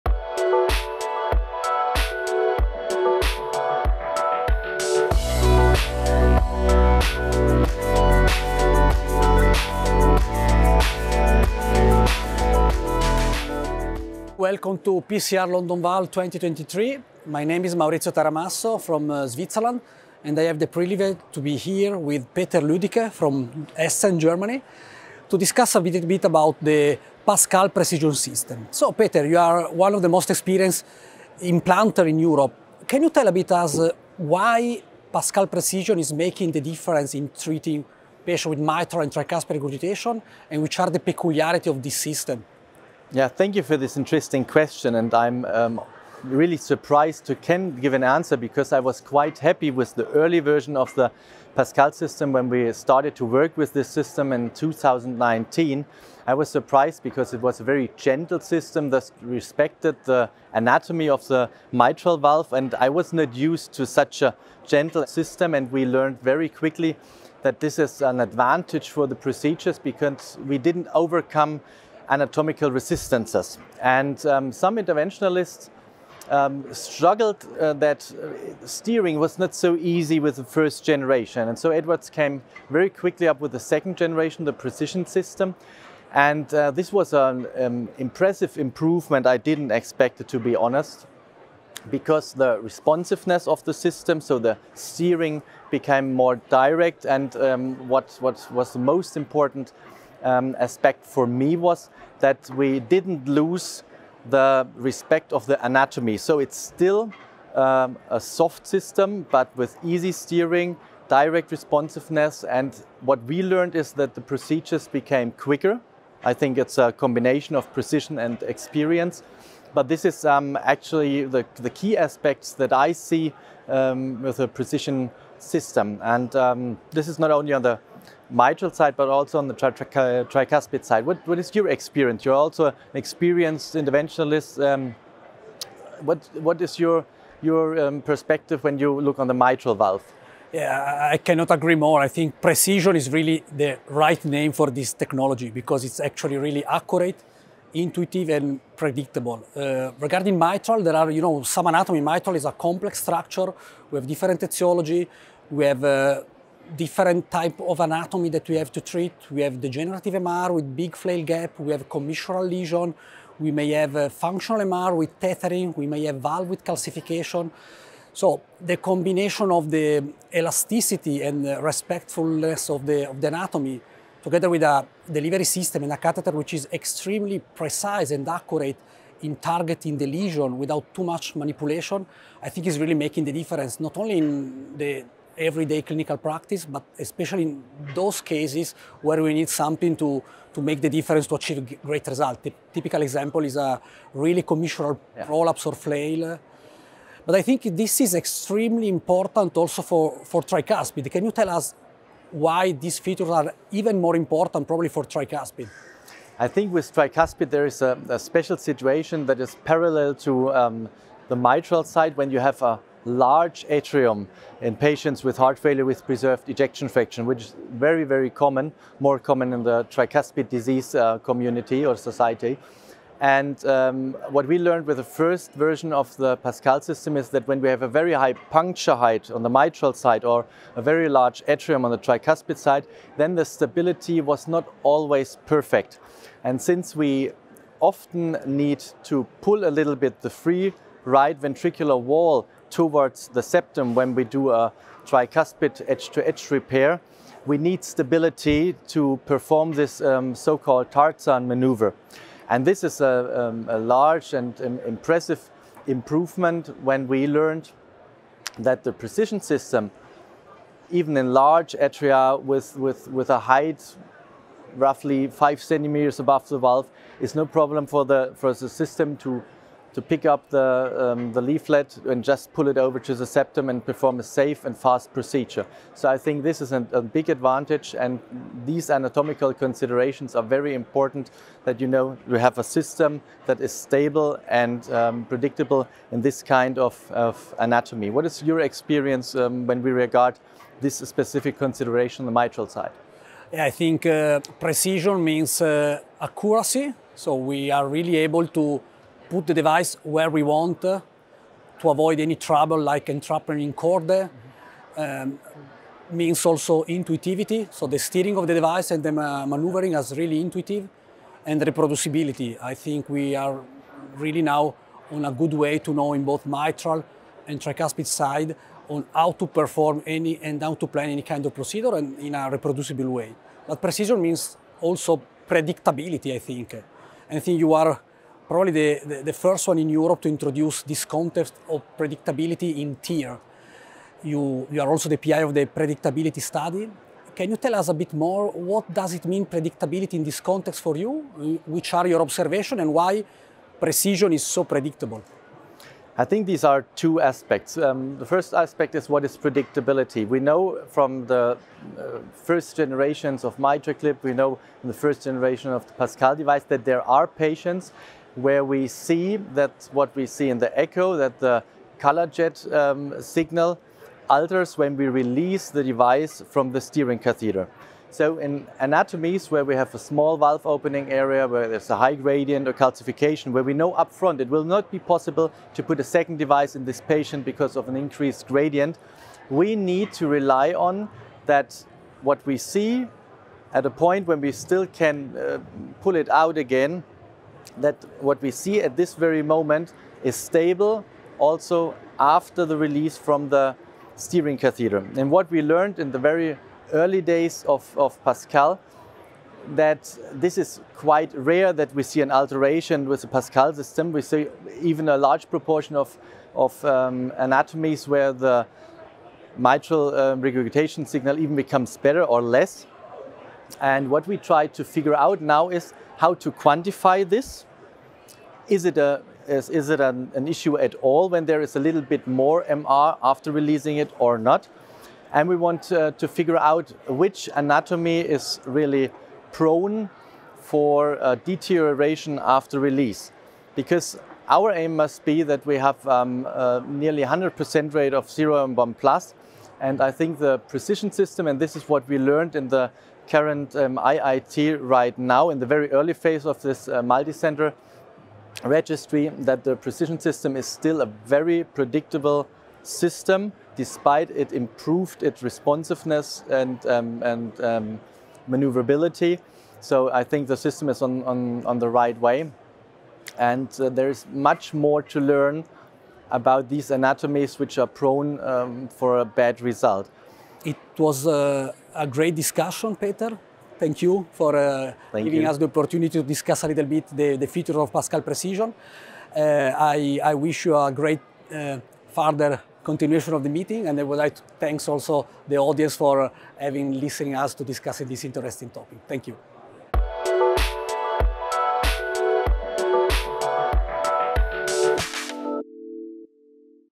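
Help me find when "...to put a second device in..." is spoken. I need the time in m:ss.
6:15.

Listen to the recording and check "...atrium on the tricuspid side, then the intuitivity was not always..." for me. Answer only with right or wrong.
wrong.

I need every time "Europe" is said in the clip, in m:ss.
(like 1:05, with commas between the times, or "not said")
0:32, 5:29.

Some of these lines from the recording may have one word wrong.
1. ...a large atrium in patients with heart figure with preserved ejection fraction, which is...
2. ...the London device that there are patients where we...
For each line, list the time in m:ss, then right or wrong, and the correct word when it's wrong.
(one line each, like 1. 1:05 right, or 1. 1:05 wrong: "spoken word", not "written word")
1. 3:32 wrong: "failure", not "figure"
2. 5:55 wrong: "Pascal", not "London".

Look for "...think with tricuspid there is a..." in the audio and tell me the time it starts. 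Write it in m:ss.
3:26.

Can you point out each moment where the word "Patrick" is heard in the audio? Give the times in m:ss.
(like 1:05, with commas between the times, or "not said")
not said.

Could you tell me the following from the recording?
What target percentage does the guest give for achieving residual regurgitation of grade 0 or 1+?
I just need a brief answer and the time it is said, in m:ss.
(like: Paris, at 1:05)
100%, at 7:17.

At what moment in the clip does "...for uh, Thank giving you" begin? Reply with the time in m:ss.
7:54.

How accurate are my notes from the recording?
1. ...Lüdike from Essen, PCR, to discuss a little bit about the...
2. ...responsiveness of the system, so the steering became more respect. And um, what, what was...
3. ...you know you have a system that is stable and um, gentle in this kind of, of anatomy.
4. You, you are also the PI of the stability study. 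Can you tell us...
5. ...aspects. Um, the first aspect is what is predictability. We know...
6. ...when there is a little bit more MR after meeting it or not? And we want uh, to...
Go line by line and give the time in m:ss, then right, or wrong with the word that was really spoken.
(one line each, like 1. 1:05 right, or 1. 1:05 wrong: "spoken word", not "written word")
1. 0:22 wrong: "Germany", not "PCR"
2. 1:32 wrong: "direct", not "respect"
3. 4:41 wrong: "predictable", not "gentle"
4. 5:34 wrong: "predictability", not "stability"
5. 5:47 right
6. 7:01 wrong: "releasing", not "meeting".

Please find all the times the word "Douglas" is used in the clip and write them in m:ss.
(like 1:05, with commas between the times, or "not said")
not said.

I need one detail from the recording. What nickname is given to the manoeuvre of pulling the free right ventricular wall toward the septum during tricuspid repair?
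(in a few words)
Tarzan maneuver.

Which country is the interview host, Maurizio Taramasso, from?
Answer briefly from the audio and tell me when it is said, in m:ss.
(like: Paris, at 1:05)
Switzerland, at 0:19.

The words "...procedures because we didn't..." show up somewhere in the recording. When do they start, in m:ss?
1:09.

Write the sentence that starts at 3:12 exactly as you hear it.
The typical example is a really commissural yeah.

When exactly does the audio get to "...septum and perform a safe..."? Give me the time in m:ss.
4:33.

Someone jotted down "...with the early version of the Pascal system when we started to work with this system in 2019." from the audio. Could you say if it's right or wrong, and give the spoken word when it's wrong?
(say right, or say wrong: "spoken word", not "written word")
right.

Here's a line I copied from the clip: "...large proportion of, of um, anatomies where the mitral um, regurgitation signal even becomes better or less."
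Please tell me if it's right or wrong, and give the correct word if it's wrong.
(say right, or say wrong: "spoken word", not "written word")
right.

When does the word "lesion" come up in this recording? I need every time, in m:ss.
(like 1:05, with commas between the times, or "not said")
2:42, 3:00.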